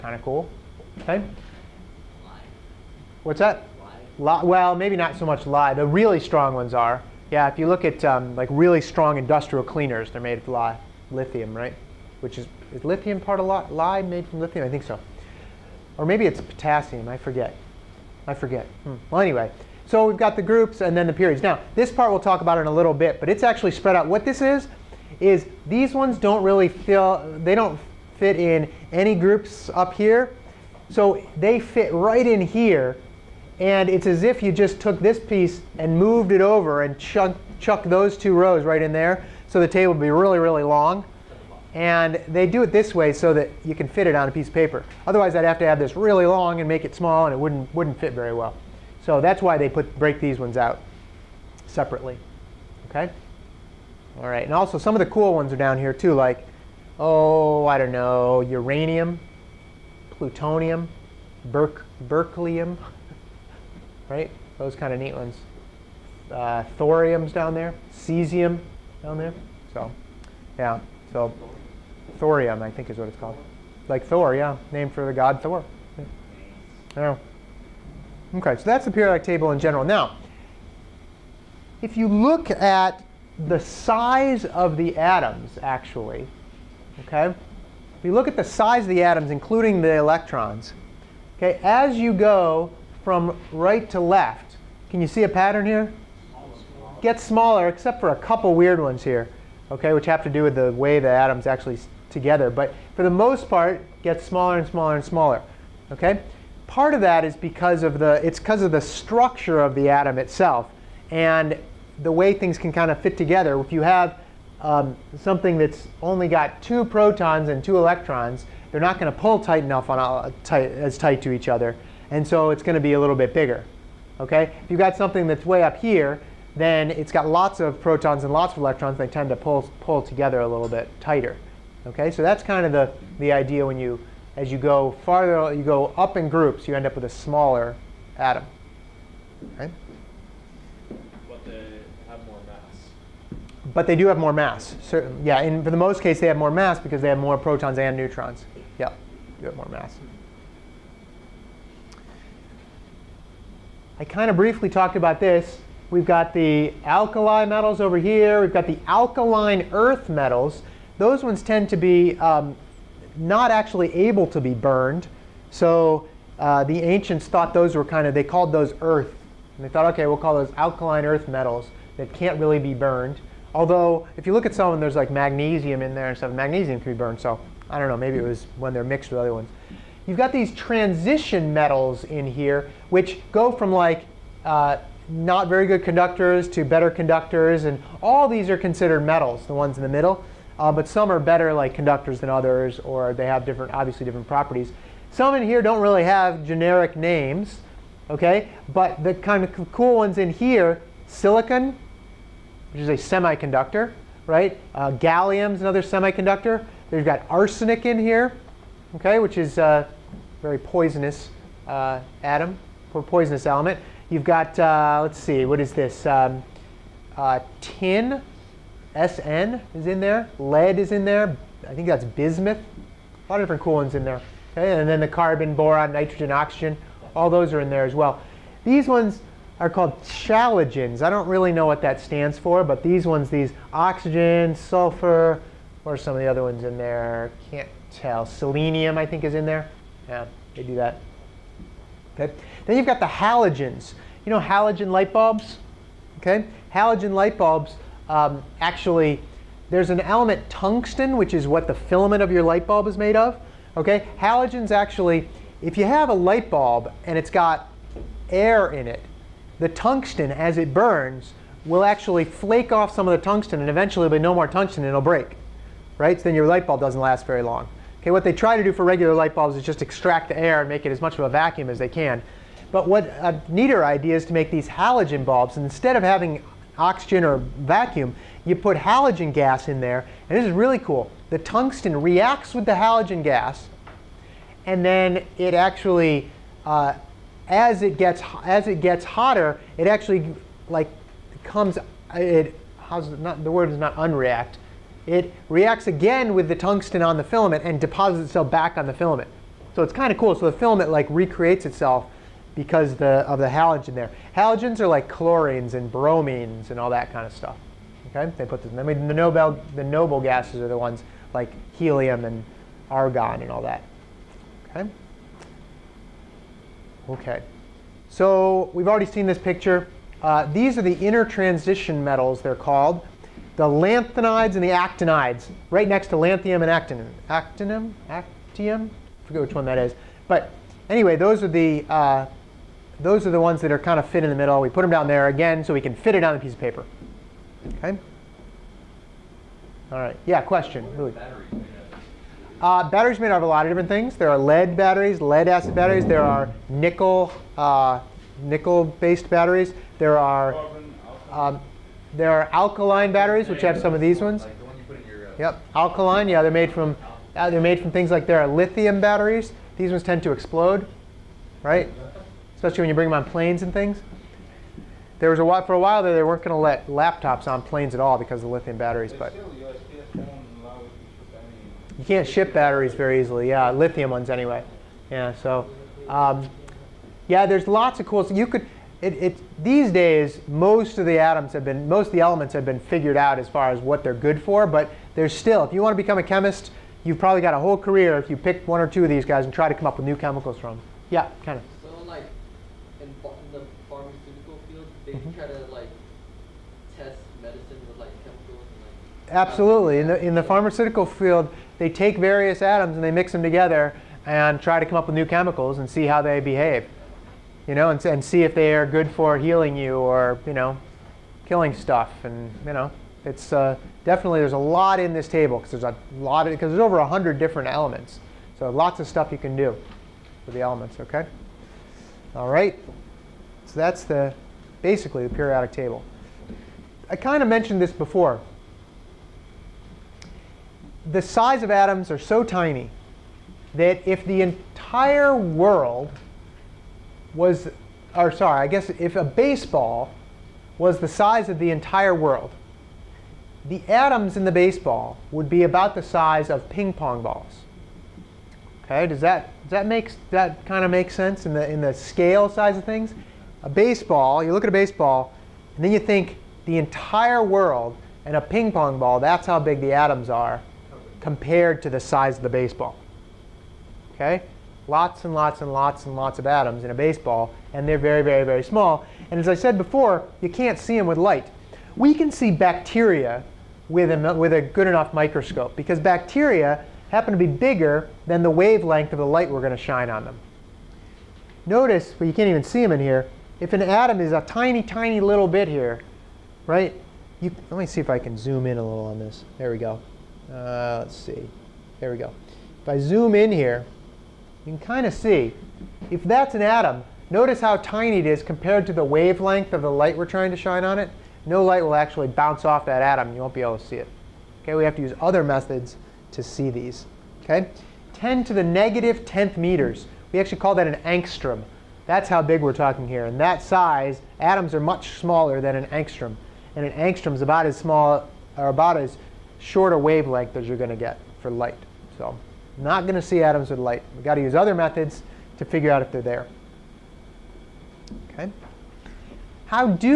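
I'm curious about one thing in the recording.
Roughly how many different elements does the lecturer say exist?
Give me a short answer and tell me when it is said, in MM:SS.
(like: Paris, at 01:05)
over 100, at 06:56.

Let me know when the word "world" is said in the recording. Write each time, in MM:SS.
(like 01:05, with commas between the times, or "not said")
07:15, 07:22, 07:37.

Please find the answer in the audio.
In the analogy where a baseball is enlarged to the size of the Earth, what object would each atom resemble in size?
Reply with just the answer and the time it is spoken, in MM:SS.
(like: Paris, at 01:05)
ping pong balls, at 07:26.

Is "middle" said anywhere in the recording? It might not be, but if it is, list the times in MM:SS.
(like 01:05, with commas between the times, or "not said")
03:09, 05:34.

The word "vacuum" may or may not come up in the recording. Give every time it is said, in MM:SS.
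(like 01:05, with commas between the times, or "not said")
04:31, 04:37.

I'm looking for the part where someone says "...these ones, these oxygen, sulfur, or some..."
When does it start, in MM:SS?
03:52.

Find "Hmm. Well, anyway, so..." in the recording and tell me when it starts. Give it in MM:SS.
00:18.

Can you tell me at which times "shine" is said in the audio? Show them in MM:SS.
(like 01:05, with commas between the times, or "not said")
07:59, 08:20.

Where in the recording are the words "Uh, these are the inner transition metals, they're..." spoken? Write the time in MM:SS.
05:20.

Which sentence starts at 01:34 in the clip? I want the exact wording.
Can you see a pattern here?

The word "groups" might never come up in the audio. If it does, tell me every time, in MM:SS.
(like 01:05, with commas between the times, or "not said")
00:20, 00:29, 02:16.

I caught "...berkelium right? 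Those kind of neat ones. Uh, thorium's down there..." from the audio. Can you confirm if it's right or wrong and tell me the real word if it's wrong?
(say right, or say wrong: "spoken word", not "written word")
right.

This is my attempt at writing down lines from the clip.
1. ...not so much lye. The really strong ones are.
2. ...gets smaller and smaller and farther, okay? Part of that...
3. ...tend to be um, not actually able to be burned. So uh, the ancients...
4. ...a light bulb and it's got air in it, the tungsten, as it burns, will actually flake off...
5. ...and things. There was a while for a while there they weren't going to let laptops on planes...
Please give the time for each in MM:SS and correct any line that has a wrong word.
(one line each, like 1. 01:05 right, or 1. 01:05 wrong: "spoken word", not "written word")
1. 00:04 right
2. 01:44 wrong: "smaller", not "farther"
3. 02:41 right
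4. 04:16 right
5. 06:03 right.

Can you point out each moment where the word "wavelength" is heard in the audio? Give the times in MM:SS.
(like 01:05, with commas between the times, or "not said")
07:58, 08:19, 08:39.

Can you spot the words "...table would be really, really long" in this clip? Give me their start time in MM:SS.
00:39.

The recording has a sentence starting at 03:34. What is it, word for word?
You've got, uh, let's see, what is this?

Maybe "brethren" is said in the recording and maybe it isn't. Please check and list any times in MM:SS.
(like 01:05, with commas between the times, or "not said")
not said.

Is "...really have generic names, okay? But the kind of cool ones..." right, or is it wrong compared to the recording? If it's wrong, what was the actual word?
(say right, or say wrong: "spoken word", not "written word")
right.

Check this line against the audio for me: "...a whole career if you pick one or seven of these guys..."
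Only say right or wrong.
wrong.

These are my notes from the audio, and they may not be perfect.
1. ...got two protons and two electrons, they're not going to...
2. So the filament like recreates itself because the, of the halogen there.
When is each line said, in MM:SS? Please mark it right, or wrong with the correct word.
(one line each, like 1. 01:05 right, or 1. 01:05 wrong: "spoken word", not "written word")
1. 01:56 right
2. 05:00 right.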